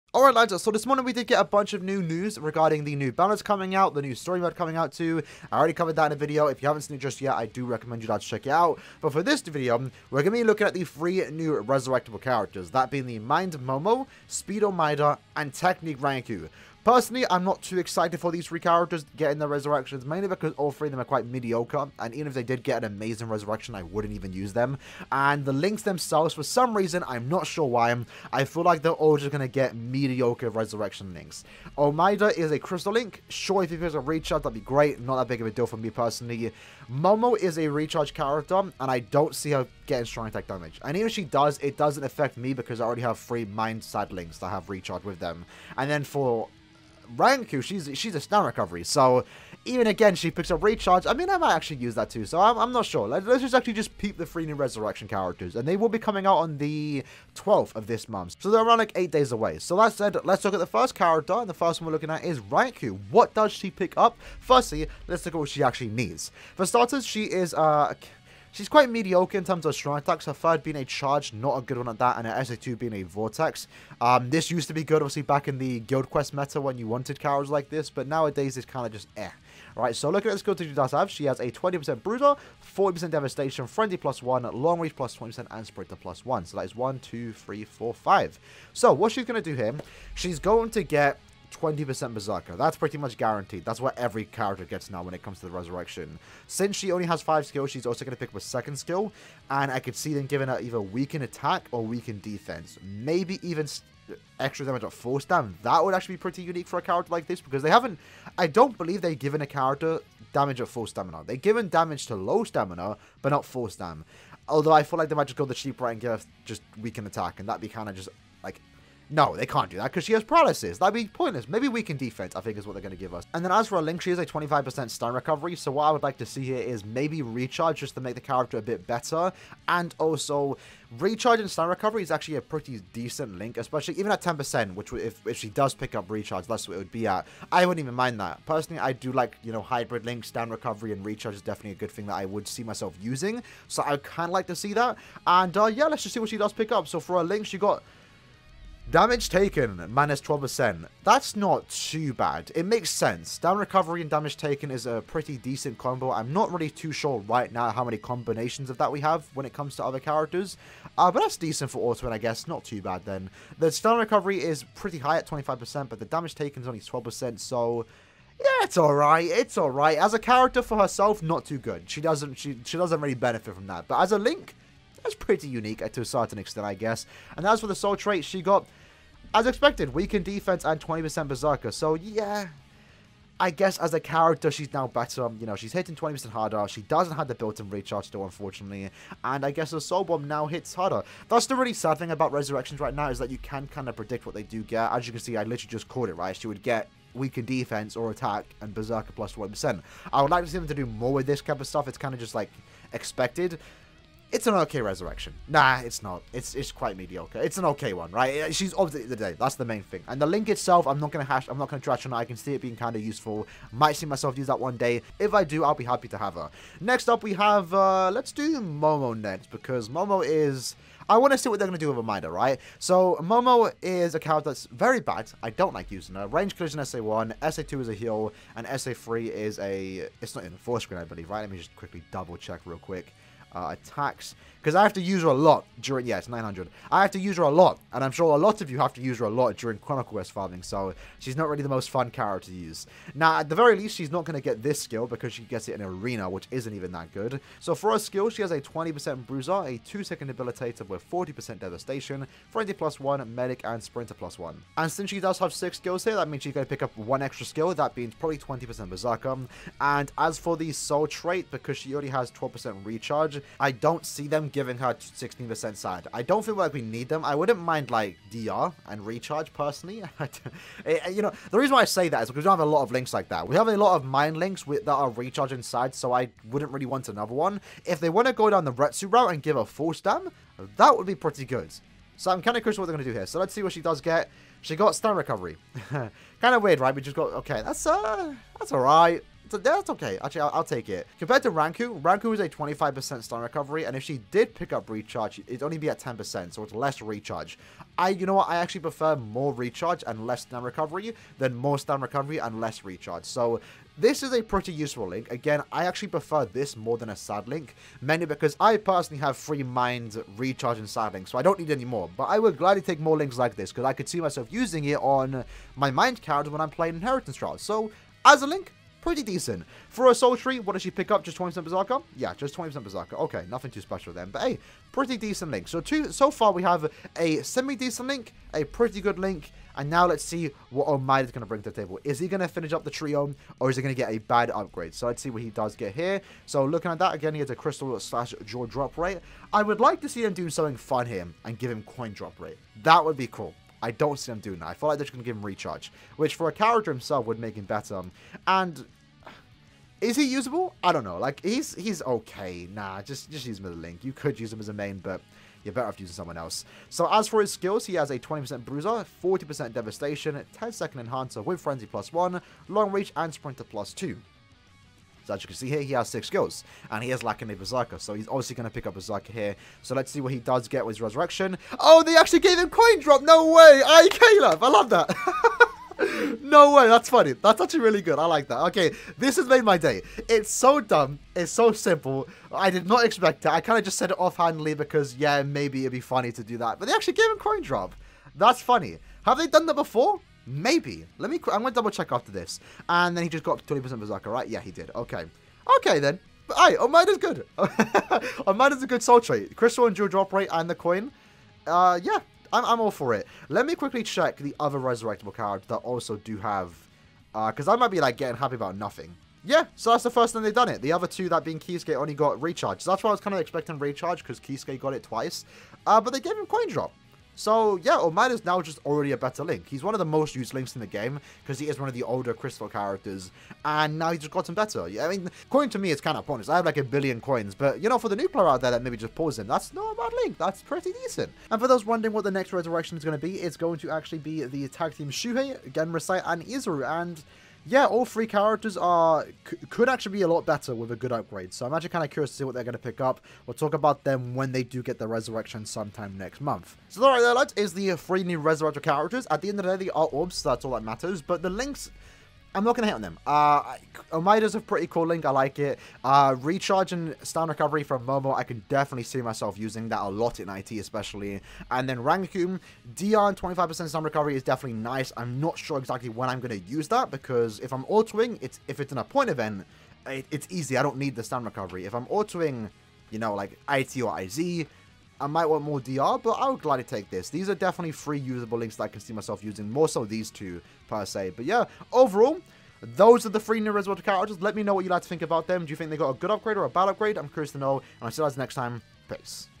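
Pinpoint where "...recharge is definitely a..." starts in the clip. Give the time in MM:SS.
02:21.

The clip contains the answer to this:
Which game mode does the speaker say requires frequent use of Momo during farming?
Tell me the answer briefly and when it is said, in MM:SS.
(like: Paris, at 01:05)
Chronicle Quest, at 03:59.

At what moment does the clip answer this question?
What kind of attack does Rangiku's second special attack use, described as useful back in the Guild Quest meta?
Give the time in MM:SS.
01:12.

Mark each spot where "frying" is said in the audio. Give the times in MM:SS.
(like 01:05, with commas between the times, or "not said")
not said.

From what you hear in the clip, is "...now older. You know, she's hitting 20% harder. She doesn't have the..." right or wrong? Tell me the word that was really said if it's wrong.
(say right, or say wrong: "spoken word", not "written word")
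wrong: "better", not "older".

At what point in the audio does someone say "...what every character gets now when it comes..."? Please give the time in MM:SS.
01:33.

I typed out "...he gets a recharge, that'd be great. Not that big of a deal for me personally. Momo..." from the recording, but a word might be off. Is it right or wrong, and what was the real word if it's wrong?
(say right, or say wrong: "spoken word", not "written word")
right.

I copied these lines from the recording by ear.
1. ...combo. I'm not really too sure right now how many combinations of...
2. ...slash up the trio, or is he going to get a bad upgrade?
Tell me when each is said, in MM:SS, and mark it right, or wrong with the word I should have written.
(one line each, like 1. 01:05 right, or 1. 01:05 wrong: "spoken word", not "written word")
1. 02:35 right
2. 05:32 wrong: "finish", not "slash".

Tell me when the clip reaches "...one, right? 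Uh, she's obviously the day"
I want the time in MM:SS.
03:27.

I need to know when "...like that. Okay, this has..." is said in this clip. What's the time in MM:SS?
06:18.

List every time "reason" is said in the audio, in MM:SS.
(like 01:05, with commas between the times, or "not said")
00:26, 04:31.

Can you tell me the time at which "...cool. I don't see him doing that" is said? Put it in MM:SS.
05:43.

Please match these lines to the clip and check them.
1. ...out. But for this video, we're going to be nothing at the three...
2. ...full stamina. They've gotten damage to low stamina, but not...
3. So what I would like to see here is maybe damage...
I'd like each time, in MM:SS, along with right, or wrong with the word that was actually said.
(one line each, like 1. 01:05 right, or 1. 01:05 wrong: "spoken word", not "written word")
1. 00:08 wrong: "looking", not "nothing"
2. 01:50 wrong: "given", not "gotten"
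3. 02:05 wrong: "recharge", not "damage".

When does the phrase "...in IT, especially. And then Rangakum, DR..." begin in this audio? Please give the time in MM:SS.
07:40.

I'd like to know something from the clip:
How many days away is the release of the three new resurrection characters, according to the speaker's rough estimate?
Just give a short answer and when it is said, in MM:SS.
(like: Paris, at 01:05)
8, at 00:58.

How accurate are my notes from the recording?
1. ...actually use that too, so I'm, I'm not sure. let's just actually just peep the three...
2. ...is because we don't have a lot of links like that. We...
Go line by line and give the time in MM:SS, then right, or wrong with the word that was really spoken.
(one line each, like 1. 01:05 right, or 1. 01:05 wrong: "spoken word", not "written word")
1. 00:51 right
2. 04:32 right.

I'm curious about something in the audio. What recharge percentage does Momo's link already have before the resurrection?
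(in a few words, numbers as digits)
12%.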